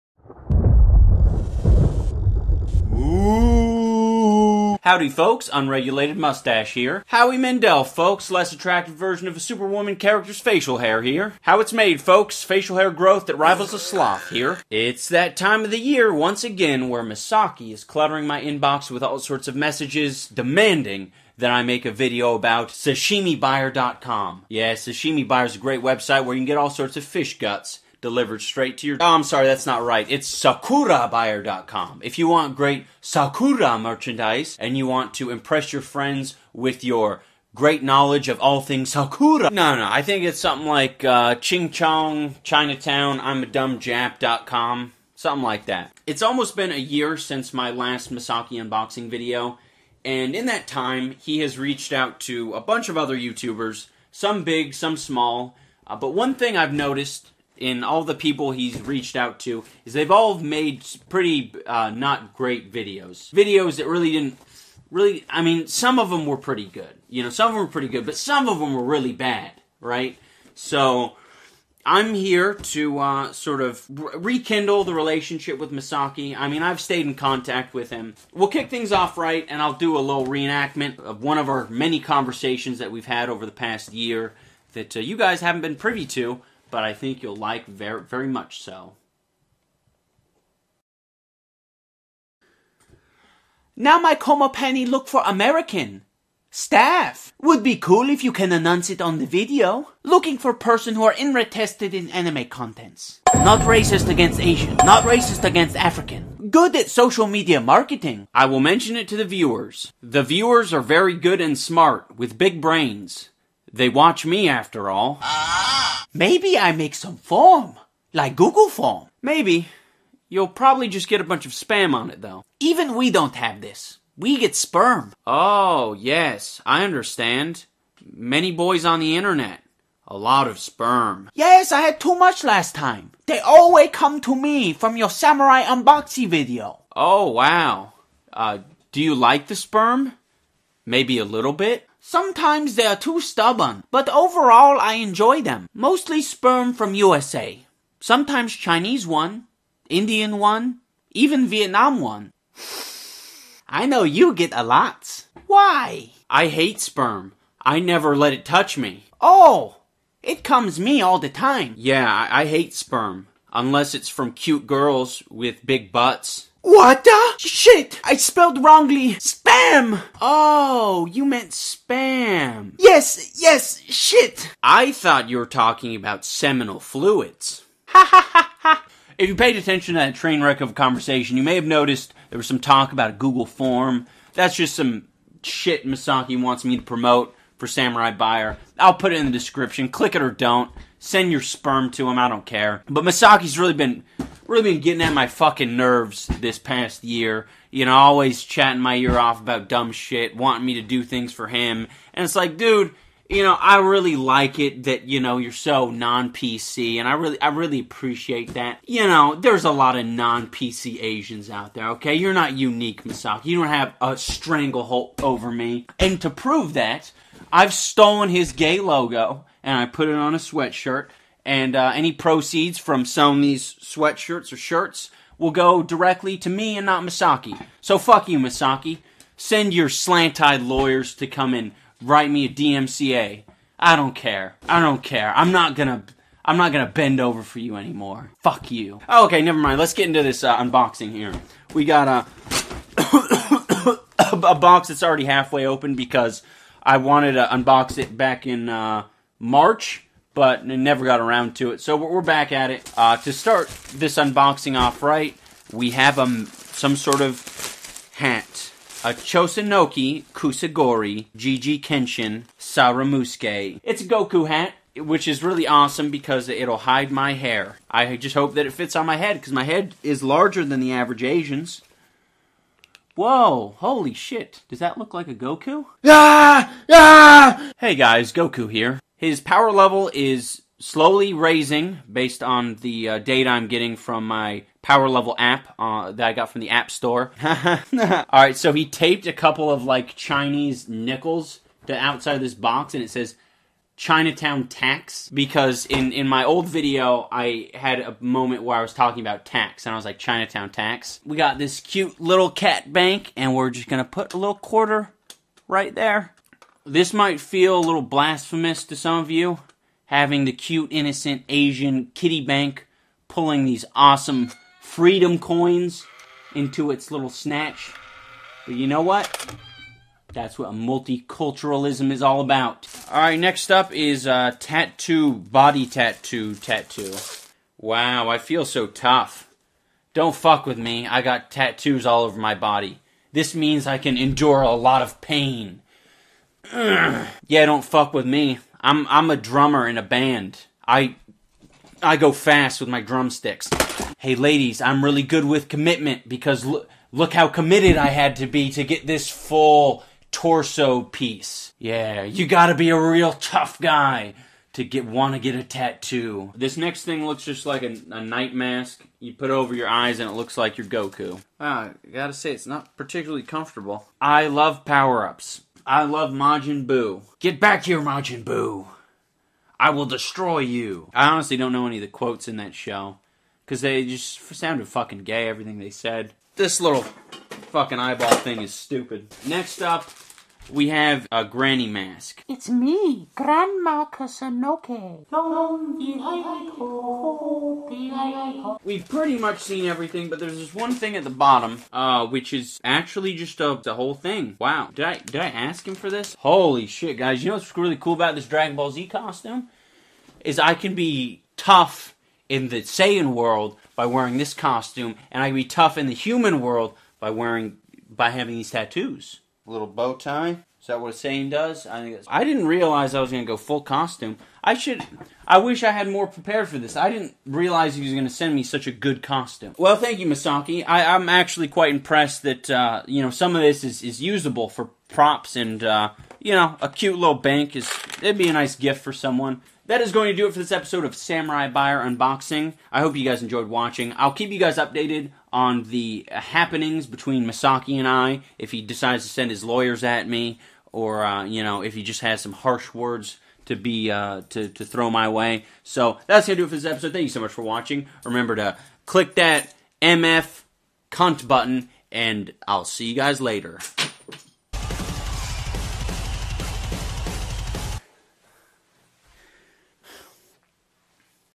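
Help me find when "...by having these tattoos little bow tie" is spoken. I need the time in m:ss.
6:48.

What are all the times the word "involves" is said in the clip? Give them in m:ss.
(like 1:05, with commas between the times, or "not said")
not said.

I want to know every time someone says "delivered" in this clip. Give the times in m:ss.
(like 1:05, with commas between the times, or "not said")
0:28.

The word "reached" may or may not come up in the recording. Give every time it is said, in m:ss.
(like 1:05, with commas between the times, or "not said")
0:51, 0:58.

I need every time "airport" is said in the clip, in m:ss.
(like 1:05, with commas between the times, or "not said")
not said.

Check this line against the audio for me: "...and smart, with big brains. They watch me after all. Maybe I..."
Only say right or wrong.
right.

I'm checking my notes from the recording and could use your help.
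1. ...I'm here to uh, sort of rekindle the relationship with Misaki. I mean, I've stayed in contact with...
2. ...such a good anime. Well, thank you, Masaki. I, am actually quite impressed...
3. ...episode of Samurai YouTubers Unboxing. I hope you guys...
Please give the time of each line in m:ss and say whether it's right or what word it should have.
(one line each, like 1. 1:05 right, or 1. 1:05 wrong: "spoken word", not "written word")
1. 1:11 right
2. 6:58 wrong: "costume", not "anime"
3. 7:10 wrong: "Buyer", not "YouTubers".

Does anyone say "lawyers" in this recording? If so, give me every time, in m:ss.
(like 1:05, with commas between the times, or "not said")
3:50, 7:19.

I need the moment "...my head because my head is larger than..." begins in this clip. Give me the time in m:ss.
4:29.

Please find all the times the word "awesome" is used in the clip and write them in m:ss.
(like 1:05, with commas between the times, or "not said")
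4:25, 5:13.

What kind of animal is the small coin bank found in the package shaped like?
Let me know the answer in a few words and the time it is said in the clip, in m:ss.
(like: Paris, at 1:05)
cat, at 5:02.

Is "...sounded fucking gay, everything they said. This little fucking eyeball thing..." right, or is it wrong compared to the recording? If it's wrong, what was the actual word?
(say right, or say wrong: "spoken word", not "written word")
right.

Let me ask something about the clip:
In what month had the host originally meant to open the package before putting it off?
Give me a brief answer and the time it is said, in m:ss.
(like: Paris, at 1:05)
March, at 4:09.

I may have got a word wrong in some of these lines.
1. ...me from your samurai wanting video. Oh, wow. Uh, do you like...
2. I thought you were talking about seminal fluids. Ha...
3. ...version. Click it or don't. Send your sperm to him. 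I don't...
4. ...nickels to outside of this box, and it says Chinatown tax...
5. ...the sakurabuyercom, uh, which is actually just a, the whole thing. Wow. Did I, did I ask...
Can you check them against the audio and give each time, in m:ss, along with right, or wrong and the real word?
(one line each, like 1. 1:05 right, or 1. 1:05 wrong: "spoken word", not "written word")
1. 2:14 wrong: "unboxing", not "wanting"
2. 2:54 right
3. 3:09 wrong: "description", not "version"
4. 4:50 right
5. 6:31 wrong: "bottom", not "sakurabuyercom".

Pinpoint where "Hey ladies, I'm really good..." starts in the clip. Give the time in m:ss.
5:44.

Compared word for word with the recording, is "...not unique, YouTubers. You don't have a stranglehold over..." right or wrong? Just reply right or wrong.
wrong.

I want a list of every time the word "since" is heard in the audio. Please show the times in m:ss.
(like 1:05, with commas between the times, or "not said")
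0:47.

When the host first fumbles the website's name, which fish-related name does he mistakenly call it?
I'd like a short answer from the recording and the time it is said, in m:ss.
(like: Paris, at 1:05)
sashimibuyer.com, at 0:22.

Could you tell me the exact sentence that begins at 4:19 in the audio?
A Chosenoki Kusagori Gigi Kenshin Saramusuke.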